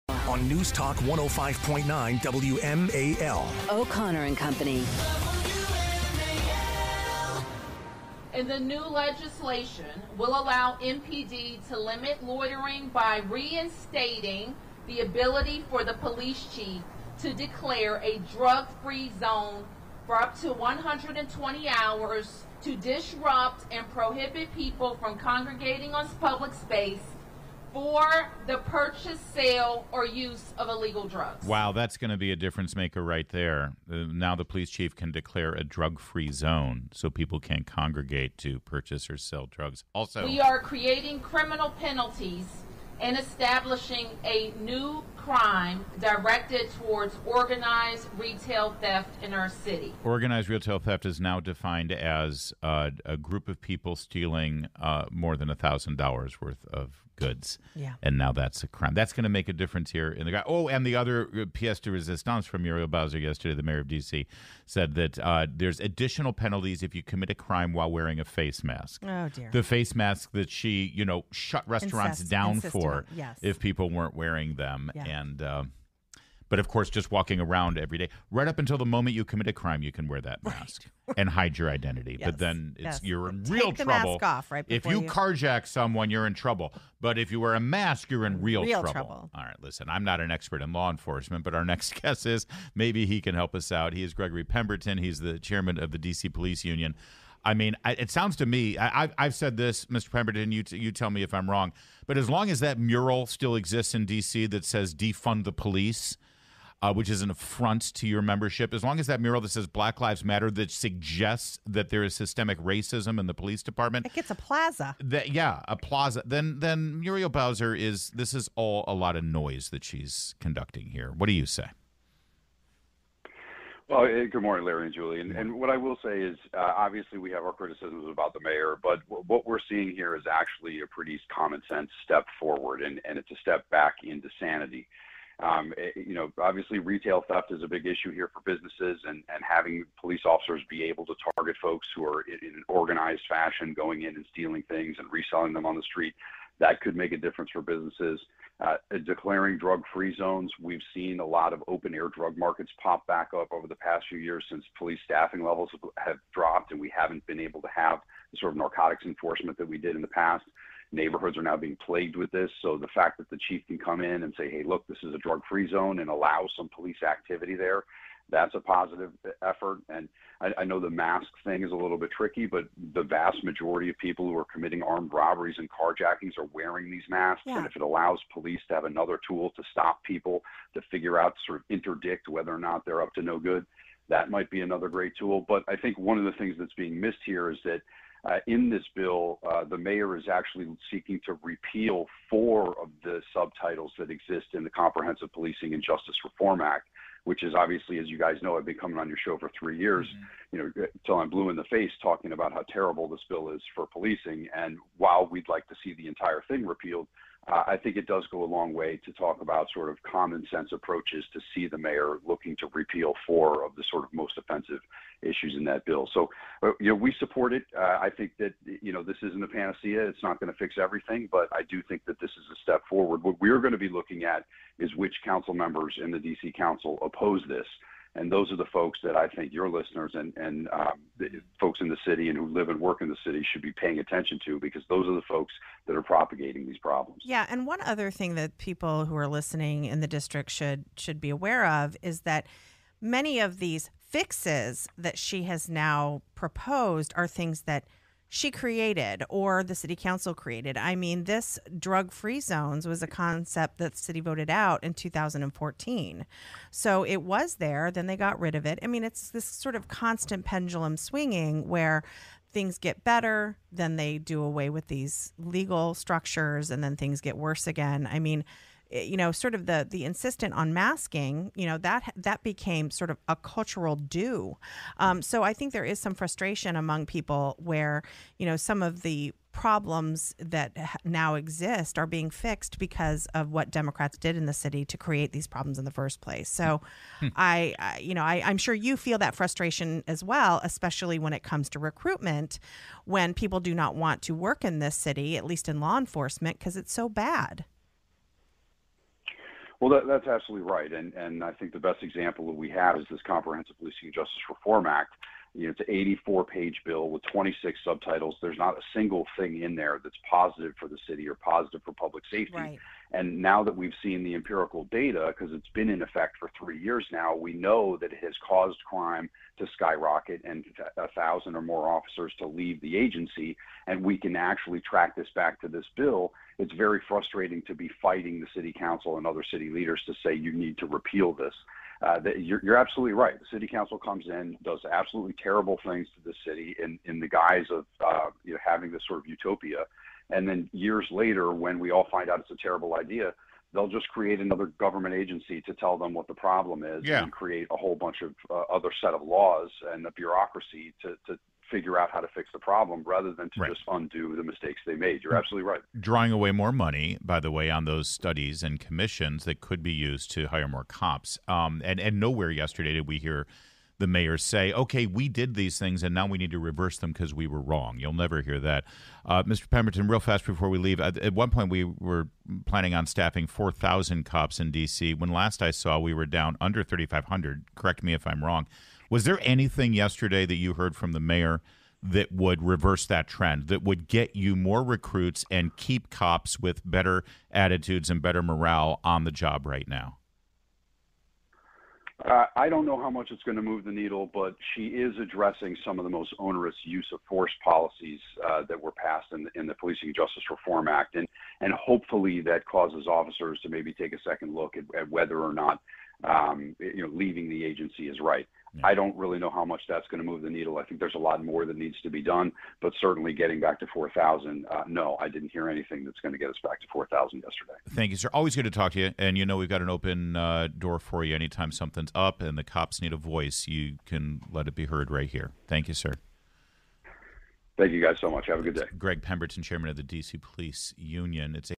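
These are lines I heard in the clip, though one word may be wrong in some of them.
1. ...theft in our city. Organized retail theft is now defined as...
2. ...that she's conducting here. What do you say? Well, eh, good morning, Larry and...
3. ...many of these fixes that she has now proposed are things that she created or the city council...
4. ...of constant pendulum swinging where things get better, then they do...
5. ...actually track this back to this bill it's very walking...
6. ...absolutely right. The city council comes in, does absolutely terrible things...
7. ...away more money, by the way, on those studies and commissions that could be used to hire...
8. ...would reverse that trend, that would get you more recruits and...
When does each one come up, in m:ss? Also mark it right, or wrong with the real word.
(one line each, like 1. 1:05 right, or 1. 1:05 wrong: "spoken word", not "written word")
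1. 0:48 right
2. 1:59 right
3. 4:03 right
4. 4:19 right
5. 5:24 wrong: "frustrating", not "walking"
6. 5:32 right
7. 5:56 right
8. 6:22 right.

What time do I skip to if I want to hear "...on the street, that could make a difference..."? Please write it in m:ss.
2:25.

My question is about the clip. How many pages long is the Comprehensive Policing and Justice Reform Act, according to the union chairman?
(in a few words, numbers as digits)
84.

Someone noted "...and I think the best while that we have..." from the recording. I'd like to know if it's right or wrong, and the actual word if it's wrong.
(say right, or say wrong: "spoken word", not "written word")
wrong: "example", not "while".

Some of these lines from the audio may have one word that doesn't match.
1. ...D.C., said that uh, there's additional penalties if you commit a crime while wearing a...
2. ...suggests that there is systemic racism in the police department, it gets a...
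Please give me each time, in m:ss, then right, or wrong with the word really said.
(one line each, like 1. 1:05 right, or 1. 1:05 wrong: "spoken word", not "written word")
1. 1:03 right
2. 1:50 right.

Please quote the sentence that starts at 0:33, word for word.
Uh, now the police chief can declare a drug free zone so people can't congregate to purchase or sell drugs.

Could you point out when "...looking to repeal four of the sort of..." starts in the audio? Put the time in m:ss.
3:32.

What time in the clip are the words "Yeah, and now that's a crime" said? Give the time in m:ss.
0:57.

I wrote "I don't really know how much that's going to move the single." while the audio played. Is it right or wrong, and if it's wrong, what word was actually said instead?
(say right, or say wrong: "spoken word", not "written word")
wrong: "needle", not "single".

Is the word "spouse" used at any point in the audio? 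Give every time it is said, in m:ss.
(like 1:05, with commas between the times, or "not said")
not said.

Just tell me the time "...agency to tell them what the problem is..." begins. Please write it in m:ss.
5:45.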